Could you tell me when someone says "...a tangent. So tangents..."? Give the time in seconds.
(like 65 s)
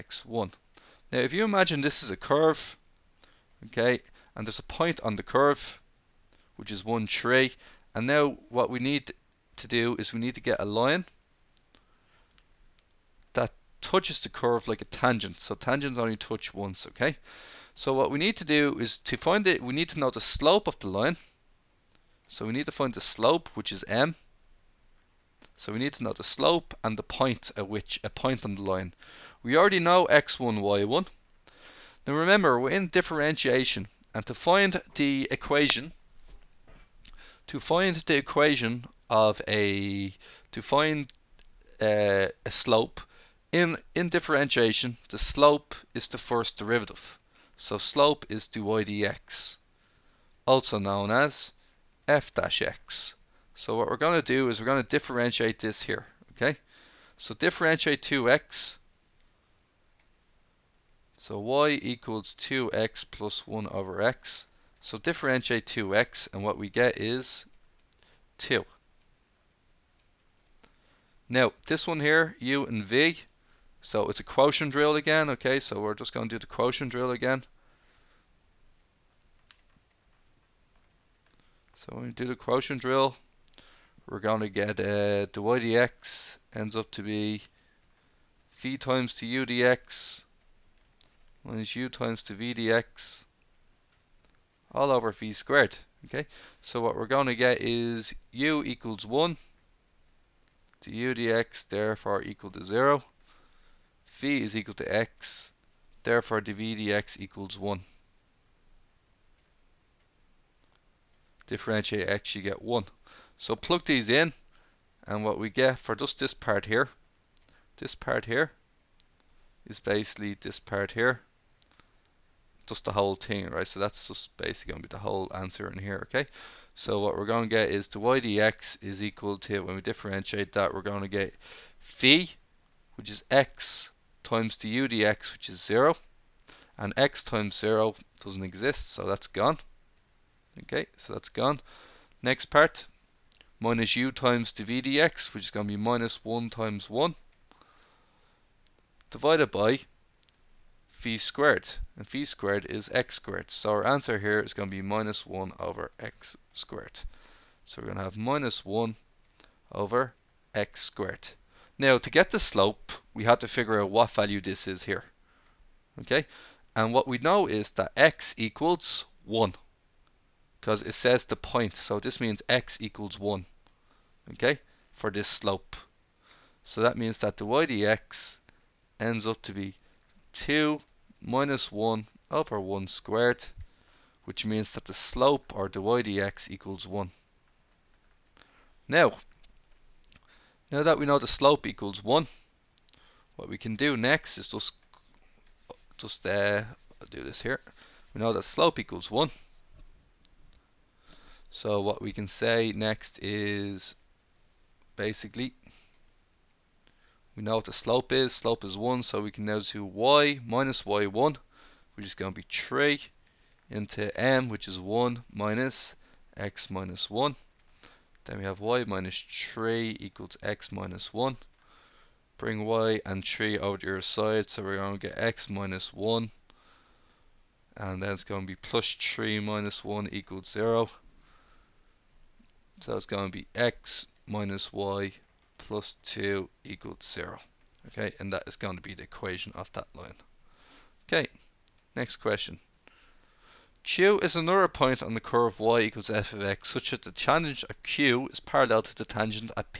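14 s.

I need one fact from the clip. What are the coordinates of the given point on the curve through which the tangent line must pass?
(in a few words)
(1, 3).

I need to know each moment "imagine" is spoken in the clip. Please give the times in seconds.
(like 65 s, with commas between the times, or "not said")
1 s.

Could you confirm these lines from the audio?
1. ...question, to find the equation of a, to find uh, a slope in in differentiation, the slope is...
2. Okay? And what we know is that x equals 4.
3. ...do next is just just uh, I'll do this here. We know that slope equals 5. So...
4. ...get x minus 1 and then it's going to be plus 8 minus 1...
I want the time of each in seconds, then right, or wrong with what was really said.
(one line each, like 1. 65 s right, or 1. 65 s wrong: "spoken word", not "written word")
1. 35 s wrong: "equation", not "question"
2. 166 s wrong: "1", not "4"
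3. 193 s wrong: "1", not "5"
4. 225 s wrong: "3", not "8".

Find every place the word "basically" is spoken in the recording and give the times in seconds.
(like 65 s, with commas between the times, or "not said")
119 s, 124 s, 204 s.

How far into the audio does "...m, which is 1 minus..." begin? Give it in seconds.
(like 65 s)
214 s.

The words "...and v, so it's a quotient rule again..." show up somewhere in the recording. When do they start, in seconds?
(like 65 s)
72 s.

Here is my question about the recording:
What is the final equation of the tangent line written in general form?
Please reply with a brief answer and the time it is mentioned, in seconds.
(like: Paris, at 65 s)
x - y + 2 = 0, at 233 s.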